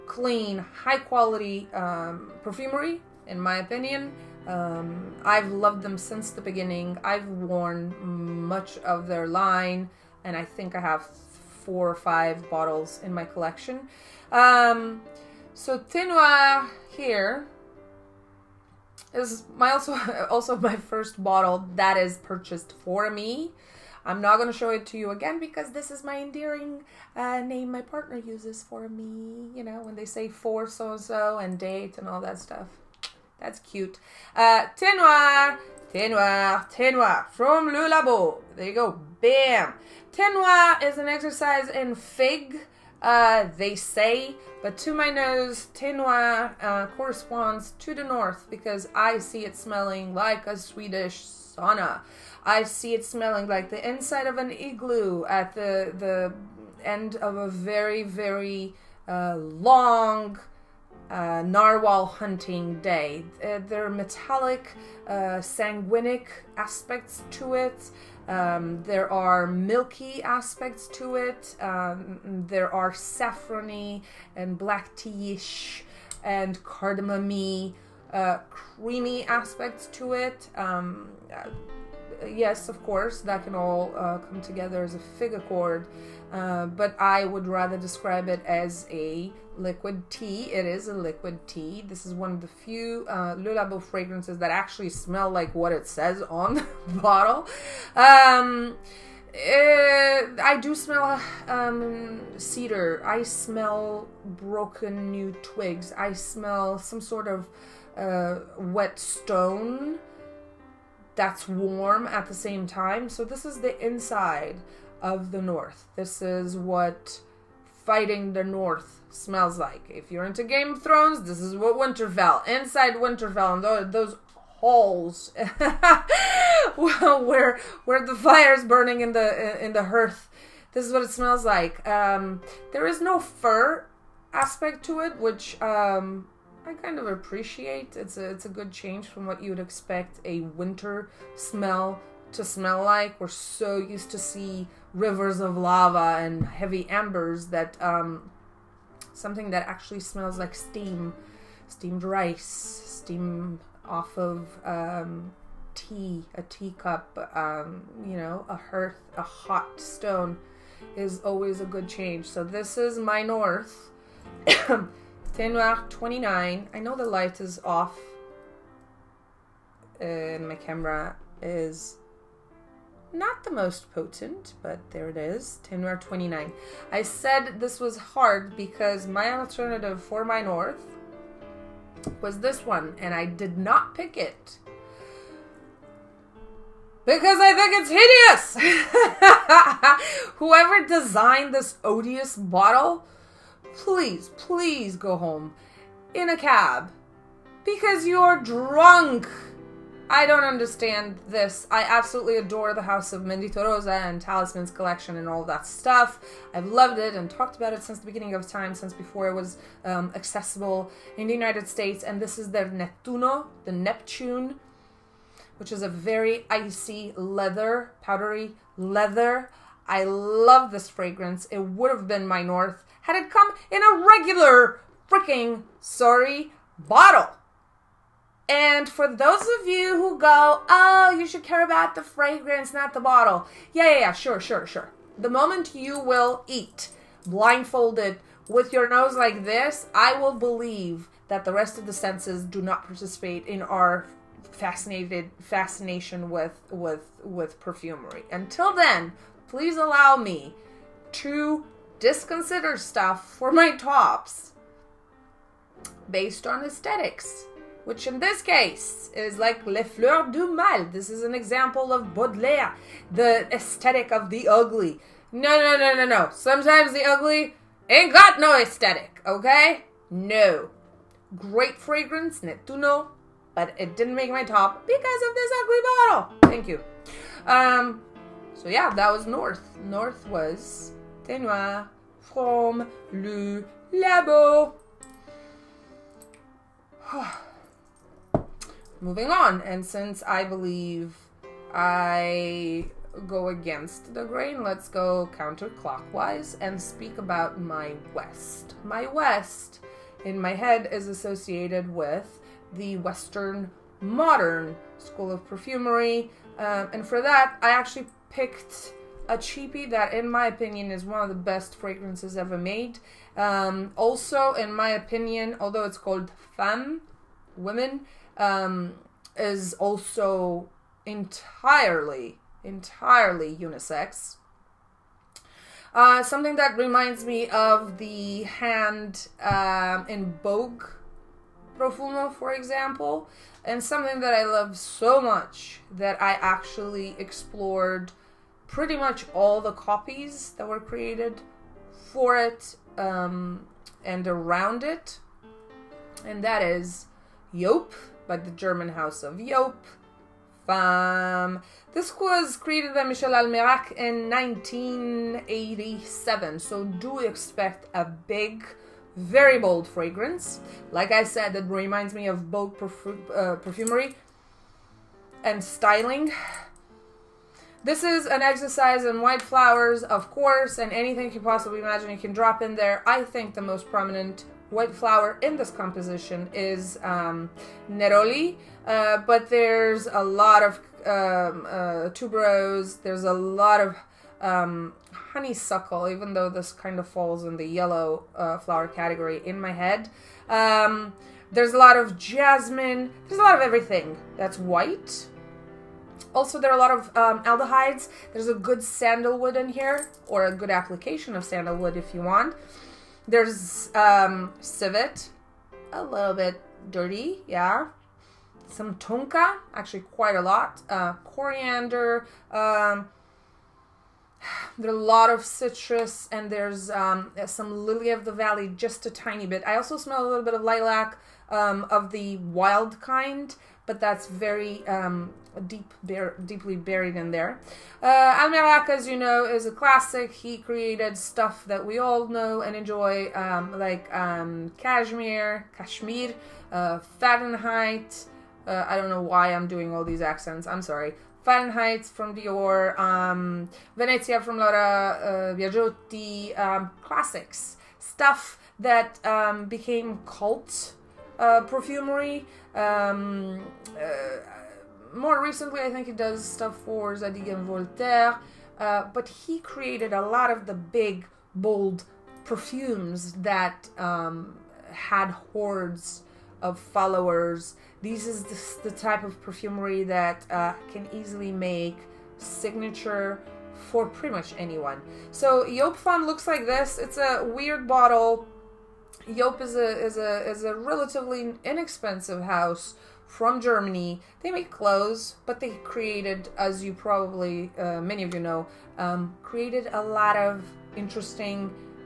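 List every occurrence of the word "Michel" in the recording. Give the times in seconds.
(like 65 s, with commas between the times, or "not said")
353 s.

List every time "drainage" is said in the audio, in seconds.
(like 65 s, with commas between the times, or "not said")
not said.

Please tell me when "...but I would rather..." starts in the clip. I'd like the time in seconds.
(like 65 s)
86 s.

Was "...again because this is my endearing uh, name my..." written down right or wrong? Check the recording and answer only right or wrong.
right.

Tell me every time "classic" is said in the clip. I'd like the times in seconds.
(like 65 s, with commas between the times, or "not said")
429 s, 447 s.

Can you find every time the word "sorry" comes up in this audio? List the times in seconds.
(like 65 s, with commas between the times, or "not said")
225 s, 440 s.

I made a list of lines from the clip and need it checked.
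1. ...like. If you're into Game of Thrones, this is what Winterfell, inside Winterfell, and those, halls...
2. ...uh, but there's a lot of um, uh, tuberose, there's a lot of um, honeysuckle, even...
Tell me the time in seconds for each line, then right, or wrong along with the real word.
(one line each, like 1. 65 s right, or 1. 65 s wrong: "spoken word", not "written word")
1. 119 s right
2. 378 s right.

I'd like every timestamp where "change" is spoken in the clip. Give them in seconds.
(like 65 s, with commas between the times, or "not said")
138 s, 161 s.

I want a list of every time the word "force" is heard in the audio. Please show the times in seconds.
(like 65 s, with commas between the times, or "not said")
not said.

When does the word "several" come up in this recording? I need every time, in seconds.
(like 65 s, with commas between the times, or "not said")
not said.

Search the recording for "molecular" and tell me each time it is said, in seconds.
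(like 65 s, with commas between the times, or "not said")
not said.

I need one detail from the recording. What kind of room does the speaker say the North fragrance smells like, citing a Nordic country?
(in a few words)
Swedish sauna.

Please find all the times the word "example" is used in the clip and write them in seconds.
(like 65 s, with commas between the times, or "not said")
261 s, 332 s.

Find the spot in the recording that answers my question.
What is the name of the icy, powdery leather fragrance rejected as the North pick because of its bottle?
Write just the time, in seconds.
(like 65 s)
212 s.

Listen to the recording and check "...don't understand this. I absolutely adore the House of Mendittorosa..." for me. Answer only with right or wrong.
right.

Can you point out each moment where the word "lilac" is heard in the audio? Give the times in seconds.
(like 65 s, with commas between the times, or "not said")
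420 s.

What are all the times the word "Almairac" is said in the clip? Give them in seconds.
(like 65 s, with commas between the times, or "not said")
353 s, 428 s.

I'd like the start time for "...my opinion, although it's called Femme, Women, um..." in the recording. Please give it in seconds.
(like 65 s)
314 s.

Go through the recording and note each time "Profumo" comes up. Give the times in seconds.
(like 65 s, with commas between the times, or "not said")
331 s.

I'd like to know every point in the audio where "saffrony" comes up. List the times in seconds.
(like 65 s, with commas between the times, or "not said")
72 s.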